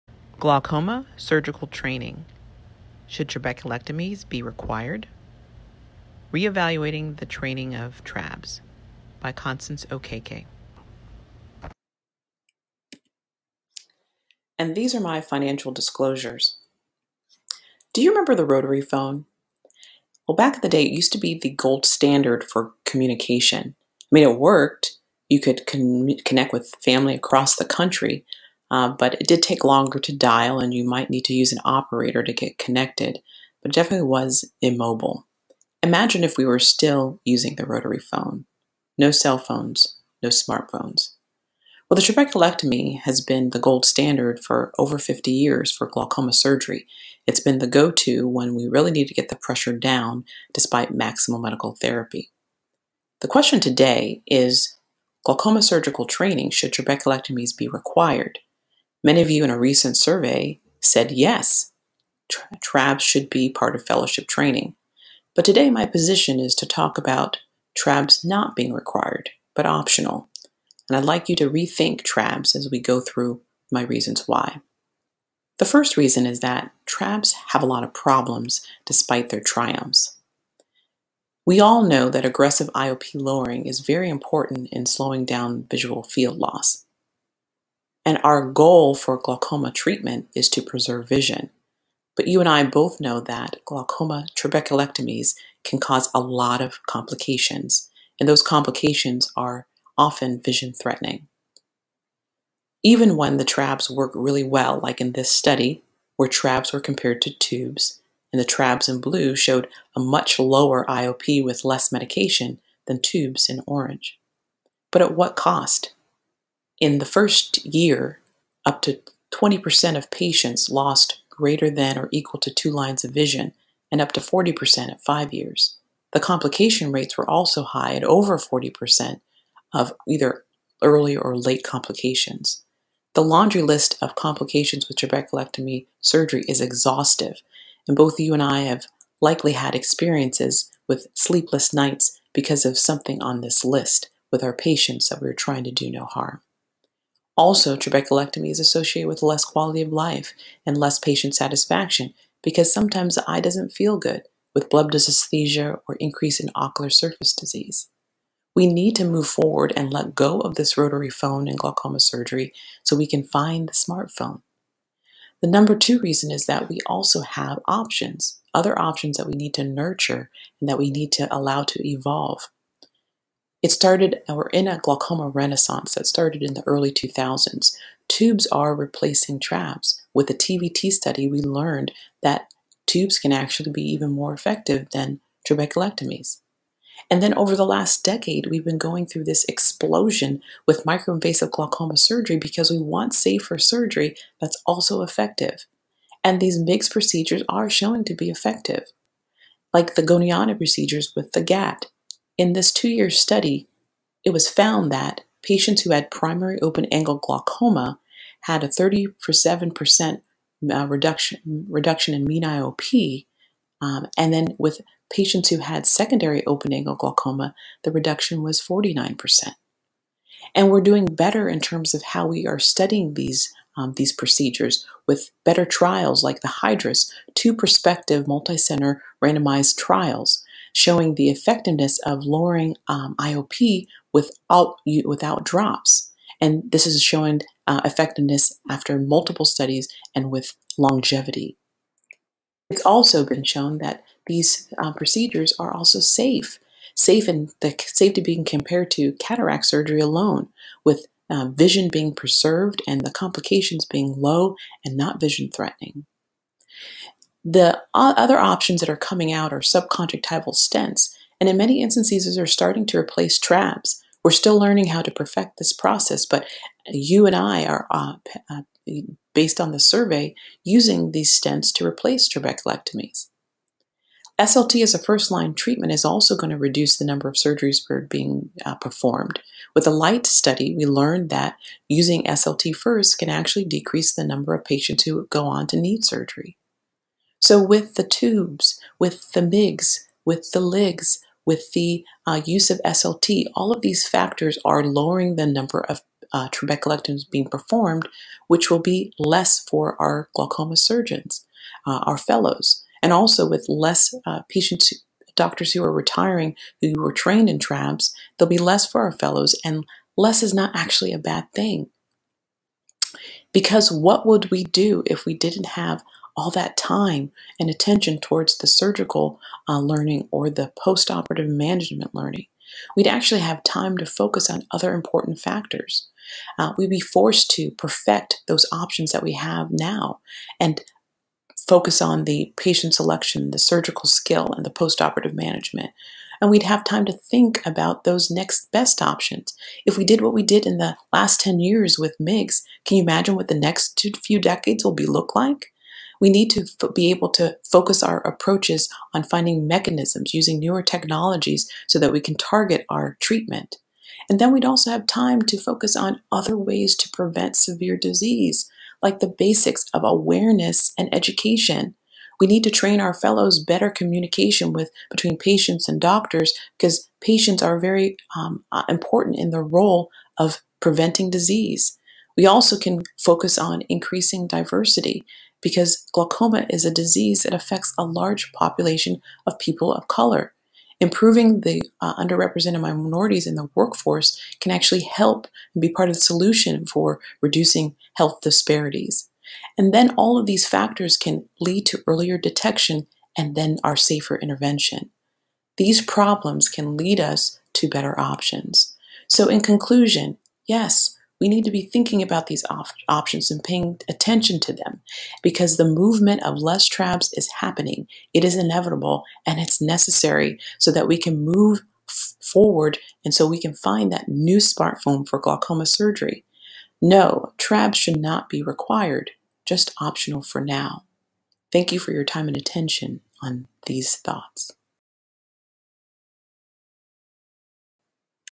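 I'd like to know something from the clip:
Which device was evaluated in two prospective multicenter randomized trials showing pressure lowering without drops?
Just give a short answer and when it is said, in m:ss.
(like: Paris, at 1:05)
Hydrus, at 3:46.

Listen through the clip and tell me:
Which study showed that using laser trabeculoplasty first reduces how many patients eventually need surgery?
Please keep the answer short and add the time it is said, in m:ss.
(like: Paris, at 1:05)
LIGHT study, at 4:39.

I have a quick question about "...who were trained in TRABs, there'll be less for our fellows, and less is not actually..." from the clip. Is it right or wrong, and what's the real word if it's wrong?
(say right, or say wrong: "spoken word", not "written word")
right.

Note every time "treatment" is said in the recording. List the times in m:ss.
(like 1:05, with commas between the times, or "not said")
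1:29, 4:35, 5:53.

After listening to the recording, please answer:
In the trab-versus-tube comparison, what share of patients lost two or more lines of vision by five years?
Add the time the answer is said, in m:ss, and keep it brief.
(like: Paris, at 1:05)
40%, at 2:04.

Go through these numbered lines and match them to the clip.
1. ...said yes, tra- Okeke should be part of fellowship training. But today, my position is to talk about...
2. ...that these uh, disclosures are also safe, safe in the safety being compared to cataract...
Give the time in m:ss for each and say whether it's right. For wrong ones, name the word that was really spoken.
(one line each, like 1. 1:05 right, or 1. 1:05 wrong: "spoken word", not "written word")
1. 1:00 wrong: "TRABs", not "Okeke"
2. 4:03 wrong: "procedures", not "disclosures".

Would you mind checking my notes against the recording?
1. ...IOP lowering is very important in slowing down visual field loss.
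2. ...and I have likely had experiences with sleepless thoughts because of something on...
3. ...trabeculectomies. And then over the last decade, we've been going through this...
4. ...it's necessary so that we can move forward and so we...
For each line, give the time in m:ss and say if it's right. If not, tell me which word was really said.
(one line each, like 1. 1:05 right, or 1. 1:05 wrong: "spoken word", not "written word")
1. 1:22 right
2. 2:18 wrong: "nights", not "thoughts"
3. 3:05 right
4. 6:49 right.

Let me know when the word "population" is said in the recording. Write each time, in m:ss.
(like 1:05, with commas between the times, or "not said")
6:18.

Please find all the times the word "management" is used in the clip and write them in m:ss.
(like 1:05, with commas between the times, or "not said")
5:21, 5:35.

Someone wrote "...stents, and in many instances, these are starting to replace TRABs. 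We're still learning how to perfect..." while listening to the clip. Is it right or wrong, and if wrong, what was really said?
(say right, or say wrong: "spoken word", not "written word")
right.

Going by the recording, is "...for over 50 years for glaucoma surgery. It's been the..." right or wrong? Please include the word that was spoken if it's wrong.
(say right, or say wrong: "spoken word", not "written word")
right.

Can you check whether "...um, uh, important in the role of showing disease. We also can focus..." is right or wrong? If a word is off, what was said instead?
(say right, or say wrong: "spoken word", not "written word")
wrong: "preventing", not "showing".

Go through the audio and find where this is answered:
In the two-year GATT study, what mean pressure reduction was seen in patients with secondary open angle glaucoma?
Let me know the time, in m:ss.
3:38.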